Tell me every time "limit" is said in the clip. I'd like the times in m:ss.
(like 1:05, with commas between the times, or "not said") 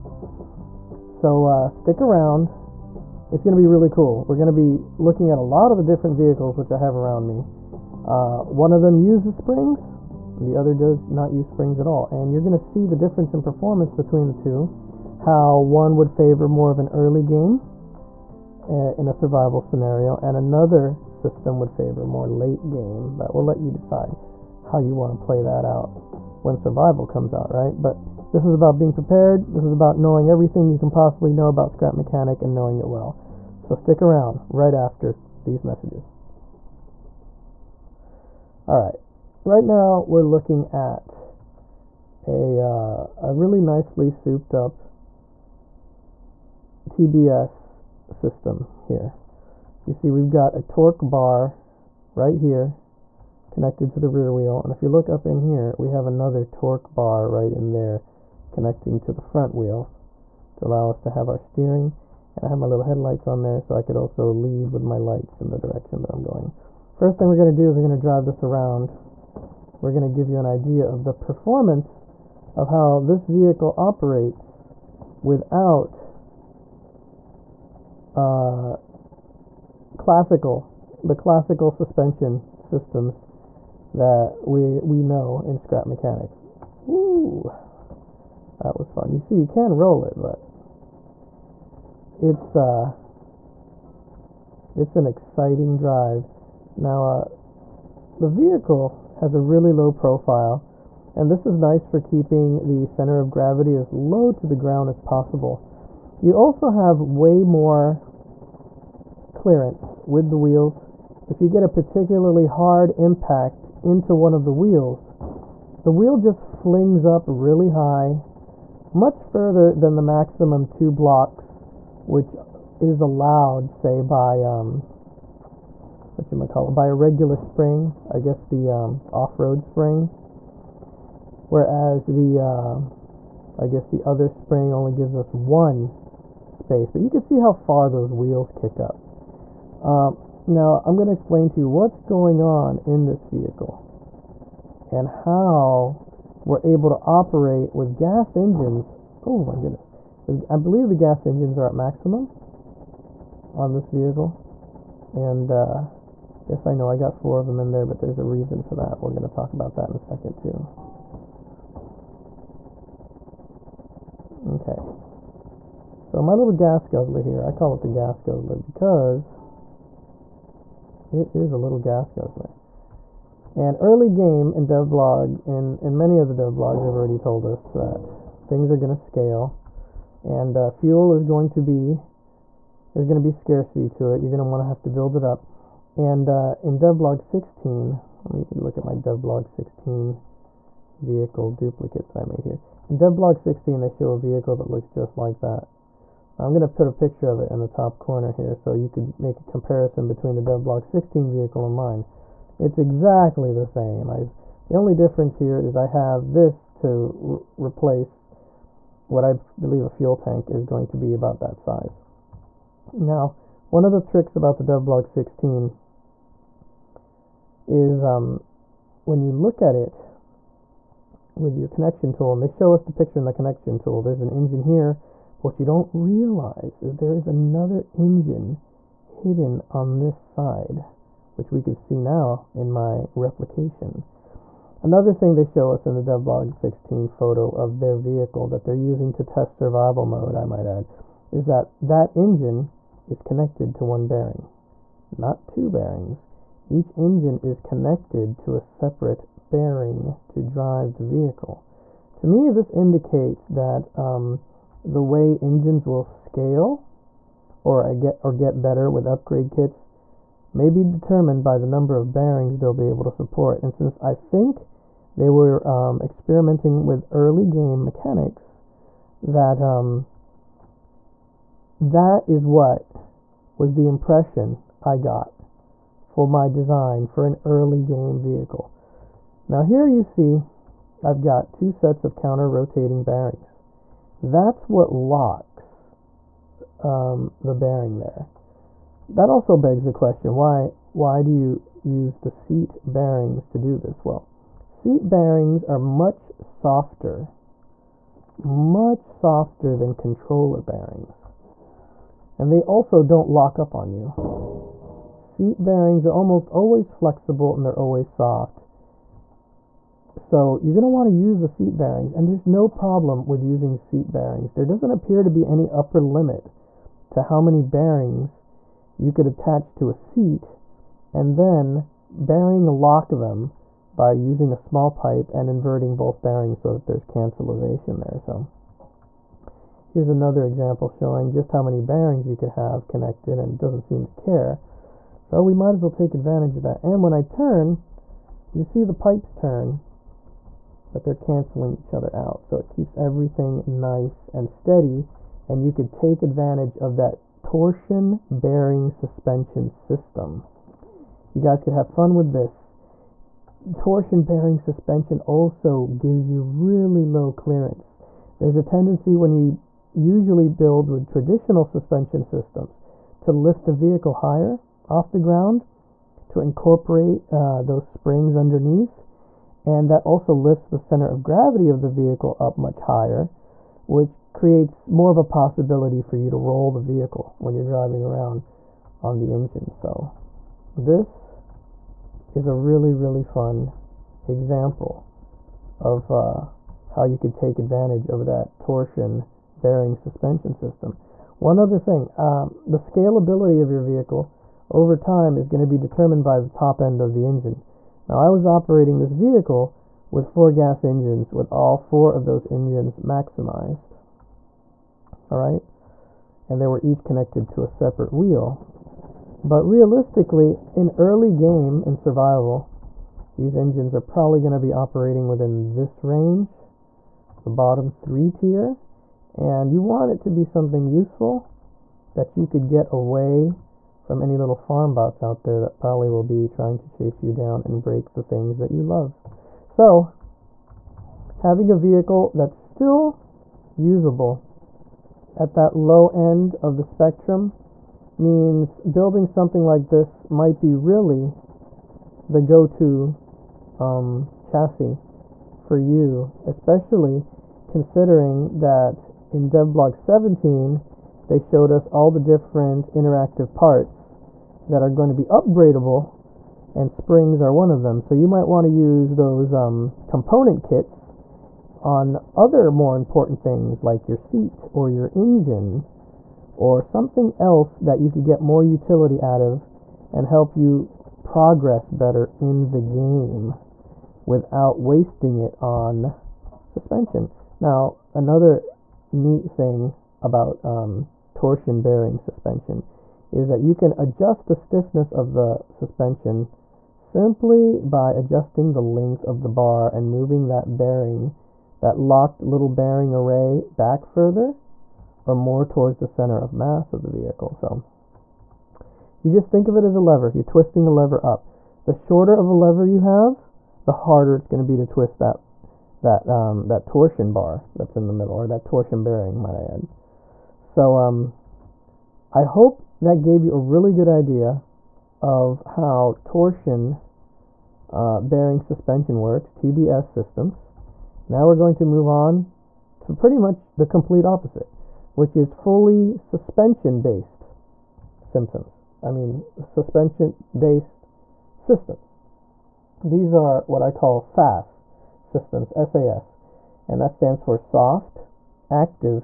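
5:15.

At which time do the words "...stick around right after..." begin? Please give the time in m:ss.
0:33.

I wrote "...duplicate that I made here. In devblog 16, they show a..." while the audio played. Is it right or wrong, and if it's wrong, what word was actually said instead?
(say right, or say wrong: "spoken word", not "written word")
right.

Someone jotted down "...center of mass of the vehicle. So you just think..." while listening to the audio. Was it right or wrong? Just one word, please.
right.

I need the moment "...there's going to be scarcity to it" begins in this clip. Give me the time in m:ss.
3:02.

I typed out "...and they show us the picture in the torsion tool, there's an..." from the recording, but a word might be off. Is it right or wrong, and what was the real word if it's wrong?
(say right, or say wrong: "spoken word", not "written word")
wrong: "connection", not "torsion".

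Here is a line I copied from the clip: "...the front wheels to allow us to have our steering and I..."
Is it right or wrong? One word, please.
right.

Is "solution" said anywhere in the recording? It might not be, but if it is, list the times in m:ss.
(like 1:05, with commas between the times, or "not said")
not said.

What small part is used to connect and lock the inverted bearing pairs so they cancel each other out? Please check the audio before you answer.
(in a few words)
small pipe.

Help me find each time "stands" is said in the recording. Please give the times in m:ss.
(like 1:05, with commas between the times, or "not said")
8:57.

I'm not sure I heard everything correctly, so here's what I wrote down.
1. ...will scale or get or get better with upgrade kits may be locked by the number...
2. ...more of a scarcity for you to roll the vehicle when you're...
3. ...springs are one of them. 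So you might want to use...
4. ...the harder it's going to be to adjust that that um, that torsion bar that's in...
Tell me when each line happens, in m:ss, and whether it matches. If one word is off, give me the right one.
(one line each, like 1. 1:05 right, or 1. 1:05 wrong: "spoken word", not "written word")
1. 4:15 wrong: "determined", not "locked"
2. 6:14 wrong: "possibility", not "scarcity"
3. 7:36 right
4. 8:23 wrong: "twist", not "adjust".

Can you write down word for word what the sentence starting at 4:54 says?
Well, seat bearings are much softer, much softer than controller bearings.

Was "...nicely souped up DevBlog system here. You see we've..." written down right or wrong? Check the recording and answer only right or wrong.
wrong.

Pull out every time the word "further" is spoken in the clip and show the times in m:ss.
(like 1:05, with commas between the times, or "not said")
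1:59, 8:14.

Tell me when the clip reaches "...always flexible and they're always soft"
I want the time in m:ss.
5:06.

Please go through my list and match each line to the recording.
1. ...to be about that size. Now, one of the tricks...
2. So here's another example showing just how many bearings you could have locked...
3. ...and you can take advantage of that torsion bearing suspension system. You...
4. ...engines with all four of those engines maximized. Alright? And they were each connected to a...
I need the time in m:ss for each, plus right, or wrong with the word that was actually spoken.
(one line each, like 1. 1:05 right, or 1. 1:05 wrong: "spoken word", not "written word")
1. 3:30 right
2. 5:28 wrong: "connected", not "locked"
3. 5:45 right
4. 6:40 right.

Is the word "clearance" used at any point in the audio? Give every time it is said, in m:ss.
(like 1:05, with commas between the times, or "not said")
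1:49, 5:57.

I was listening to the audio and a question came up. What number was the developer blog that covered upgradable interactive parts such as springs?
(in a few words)
17.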